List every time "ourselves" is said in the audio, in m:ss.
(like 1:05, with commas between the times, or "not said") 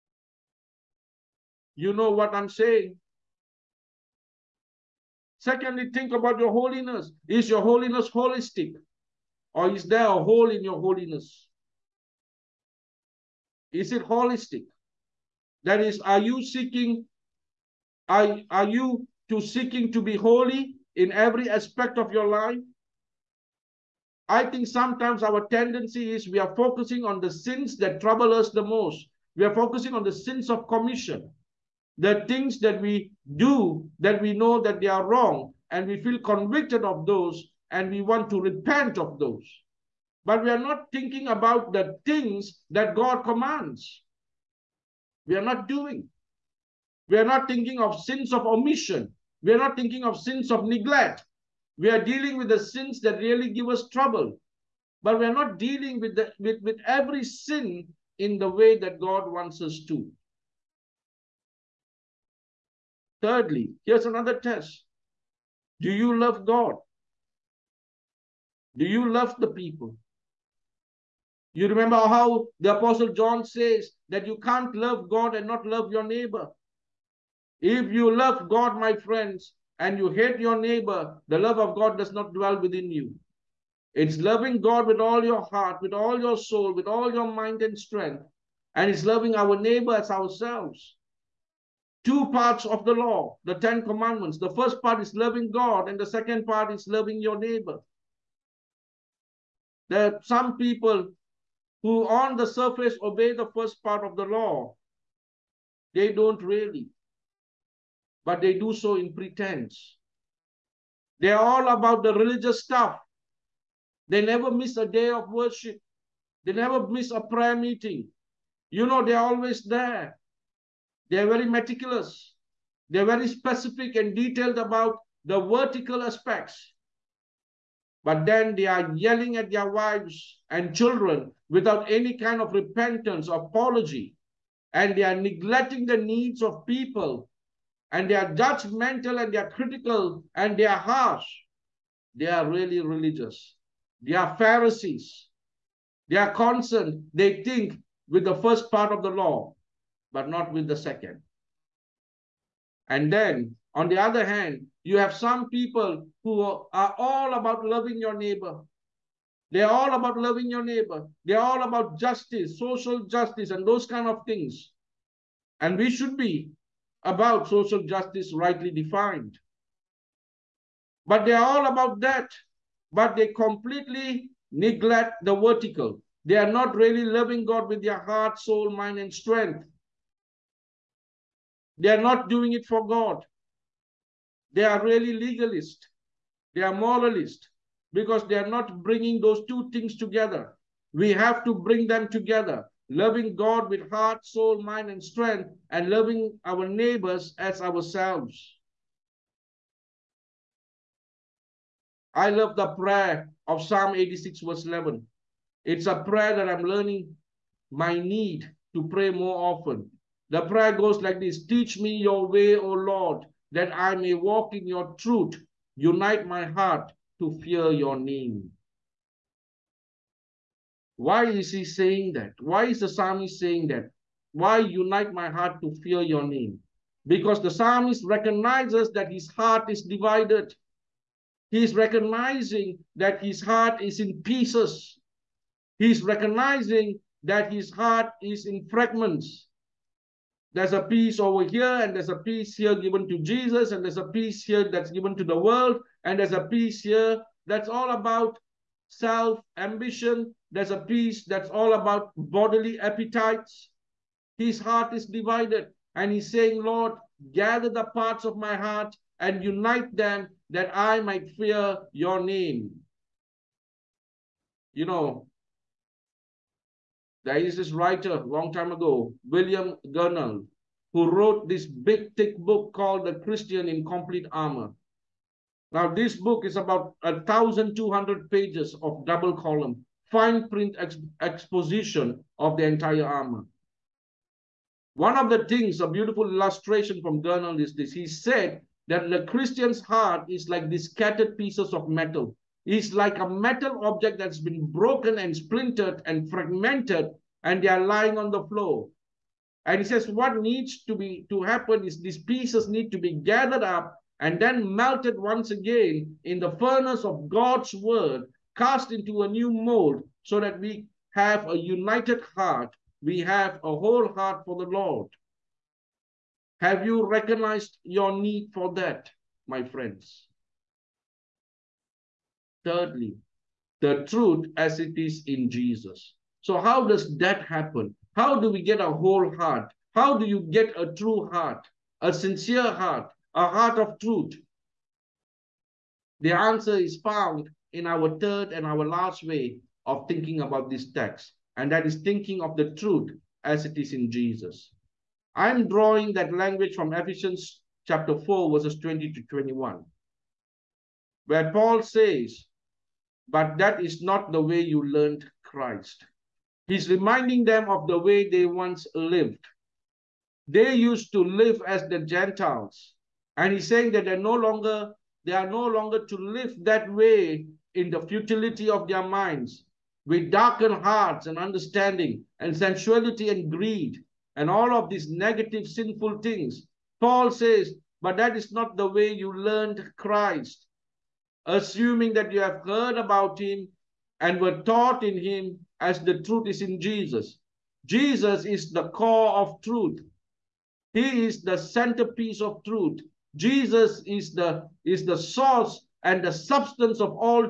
1:30, 3:17.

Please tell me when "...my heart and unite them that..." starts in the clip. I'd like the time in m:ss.
4:18.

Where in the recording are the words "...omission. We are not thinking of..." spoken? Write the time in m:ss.
0:48.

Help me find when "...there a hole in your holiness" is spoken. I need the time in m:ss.
0:09.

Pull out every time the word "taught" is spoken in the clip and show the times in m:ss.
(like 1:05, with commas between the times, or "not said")
6:24.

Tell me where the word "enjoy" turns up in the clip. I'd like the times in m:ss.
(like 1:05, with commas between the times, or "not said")
not said.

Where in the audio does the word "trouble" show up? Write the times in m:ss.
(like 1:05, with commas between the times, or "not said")
0:28, 0:53.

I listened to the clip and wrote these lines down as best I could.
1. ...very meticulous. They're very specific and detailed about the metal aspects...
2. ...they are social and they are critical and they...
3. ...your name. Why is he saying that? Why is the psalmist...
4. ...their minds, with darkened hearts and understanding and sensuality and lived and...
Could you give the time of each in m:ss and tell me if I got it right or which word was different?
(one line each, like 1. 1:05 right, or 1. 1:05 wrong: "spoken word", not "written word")
1. 2:01 wrong: "vertical", not "metal"
2. 2:18 wrong: "judgmental", not "social"
3. 3:37 right
4. 6:08 wrong: "greed", not "lived".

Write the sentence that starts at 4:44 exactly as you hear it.
One of the things, a beautiful illustration from Gurnall is this.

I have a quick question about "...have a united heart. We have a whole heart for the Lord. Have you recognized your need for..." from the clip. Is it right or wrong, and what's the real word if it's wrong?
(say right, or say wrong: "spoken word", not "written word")
right.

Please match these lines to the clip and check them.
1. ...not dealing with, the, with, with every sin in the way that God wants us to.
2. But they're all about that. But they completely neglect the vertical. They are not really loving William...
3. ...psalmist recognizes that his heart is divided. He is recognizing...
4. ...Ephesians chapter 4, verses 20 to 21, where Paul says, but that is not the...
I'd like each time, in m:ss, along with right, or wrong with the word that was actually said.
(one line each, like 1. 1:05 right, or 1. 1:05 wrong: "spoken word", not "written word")
1. 0:55 right
2. 2:51 wrong: "God", not "William"
3. 3:47 right
4. 5:46 right.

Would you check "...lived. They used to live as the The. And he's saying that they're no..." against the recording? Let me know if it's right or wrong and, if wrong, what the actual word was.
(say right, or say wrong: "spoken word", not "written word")
wrong: "Gentiles", not "The".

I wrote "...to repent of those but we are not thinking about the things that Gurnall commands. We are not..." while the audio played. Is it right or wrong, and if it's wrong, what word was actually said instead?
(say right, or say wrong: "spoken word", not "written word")
wrong: "God", not "Gurnall".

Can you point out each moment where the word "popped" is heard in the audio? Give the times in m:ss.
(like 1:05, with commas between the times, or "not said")
not said.